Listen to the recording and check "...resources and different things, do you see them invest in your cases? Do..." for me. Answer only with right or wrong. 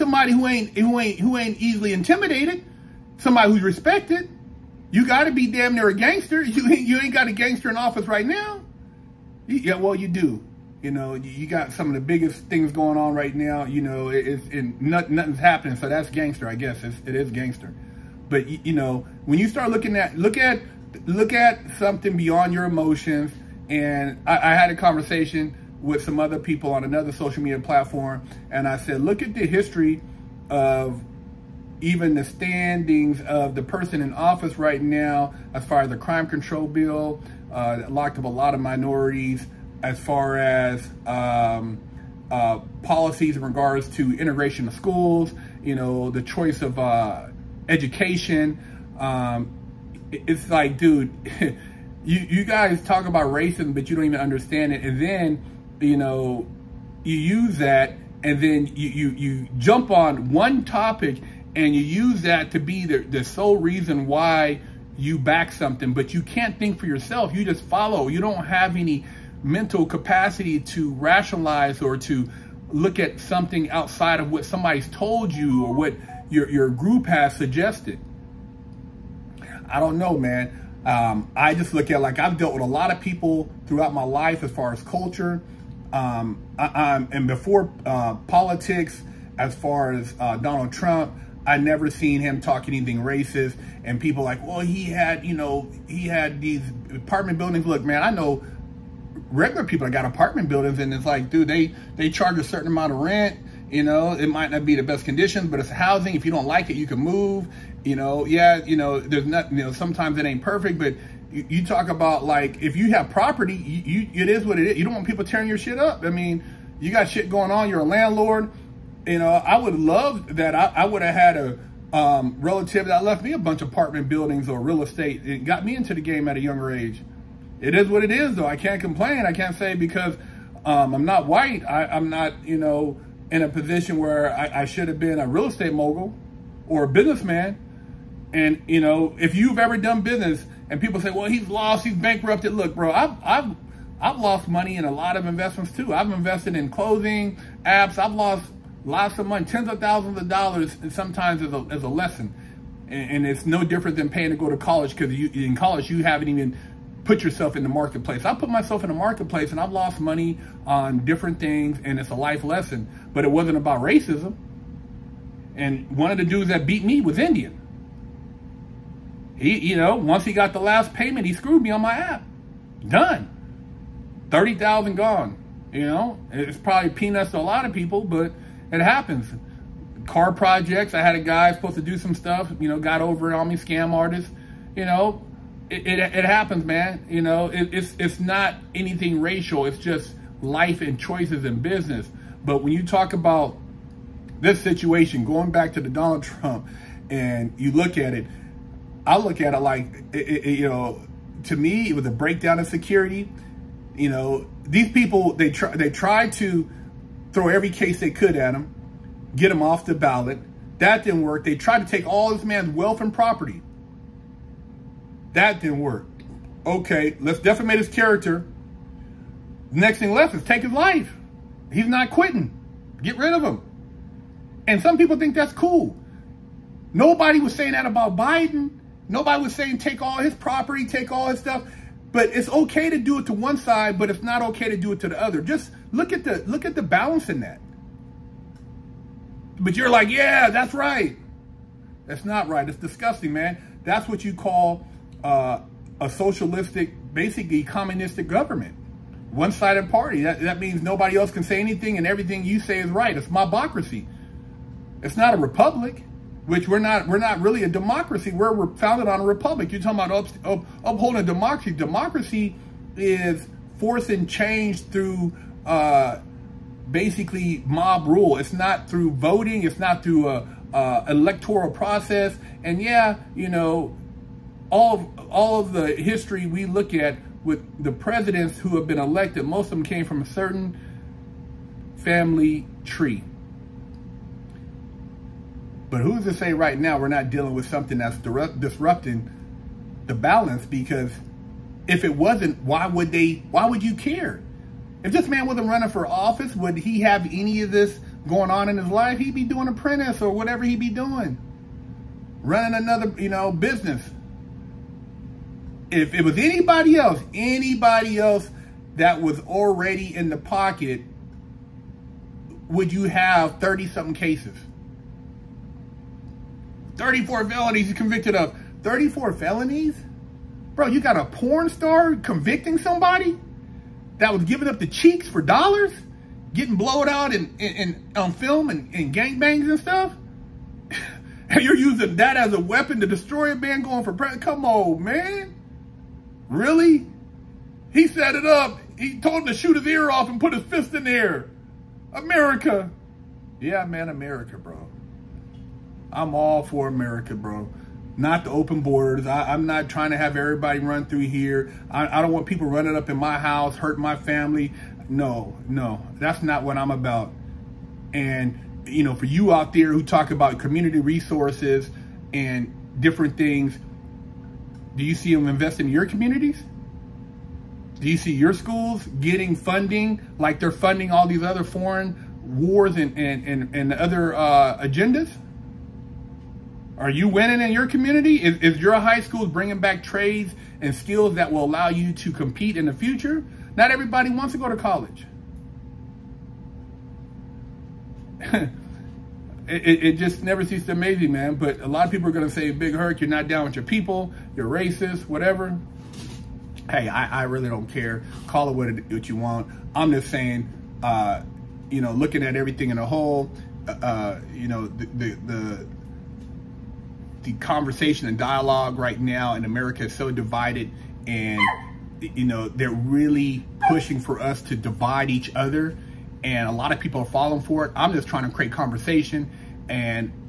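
wrong.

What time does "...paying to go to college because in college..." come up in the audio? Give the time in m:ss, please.
2:34.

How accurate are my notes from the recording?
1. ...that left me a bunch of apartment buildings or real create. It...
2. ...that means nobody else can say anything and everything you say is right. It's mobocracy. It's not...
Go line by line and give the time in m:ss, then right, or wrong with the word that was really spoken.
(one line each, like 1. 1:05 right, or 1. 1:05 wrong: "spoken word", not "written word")
1. 2:02 wrong: "estate", not "create"
2. 4:10 right.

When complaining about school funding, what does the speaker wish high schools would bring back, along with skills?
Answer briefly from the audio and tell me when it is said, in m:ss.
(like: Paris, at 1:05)
trades, at 6:20.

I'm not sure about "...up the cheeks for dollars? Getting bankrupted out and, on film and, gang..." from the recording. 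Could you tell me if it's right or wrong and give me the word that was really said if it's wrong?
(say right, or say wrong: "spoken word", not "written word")
wrong: "blowed", not "bankrupted".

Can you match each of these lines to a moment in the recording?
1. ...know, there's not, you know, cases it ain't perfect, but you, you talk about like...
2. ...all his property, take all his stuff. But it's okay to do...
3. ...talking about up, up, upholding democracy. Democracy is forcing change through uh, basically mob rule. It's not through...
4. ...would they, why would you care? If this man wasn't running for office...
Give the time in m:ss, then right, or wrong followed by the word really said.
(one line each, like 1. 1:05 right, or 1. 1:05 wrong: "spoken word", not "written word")
1. 1:48 wrong: "sometimes", not "cases"
2. 3:50 right
3. 4:19 right
4. 4:52 right.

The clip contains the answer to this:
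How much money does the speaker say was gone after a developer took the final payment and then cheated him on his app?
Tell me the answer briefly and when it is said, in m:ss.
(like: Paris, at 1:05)
30,000, at 2:54.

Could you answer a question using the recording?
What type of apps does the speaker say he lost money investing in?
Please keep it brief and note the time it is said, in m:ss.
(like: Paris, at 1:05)
clothing apps, at 2:26.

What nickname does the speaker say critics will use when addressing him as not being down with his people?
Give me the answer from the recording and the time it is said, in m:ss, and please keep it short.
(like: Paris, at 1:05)
Big Herc, at 6:32.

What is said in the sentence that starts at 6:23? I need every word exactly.
Not everybody wants to go to college.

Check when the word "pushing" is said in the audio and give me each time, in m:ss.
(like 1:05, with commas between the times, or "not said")
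6:53.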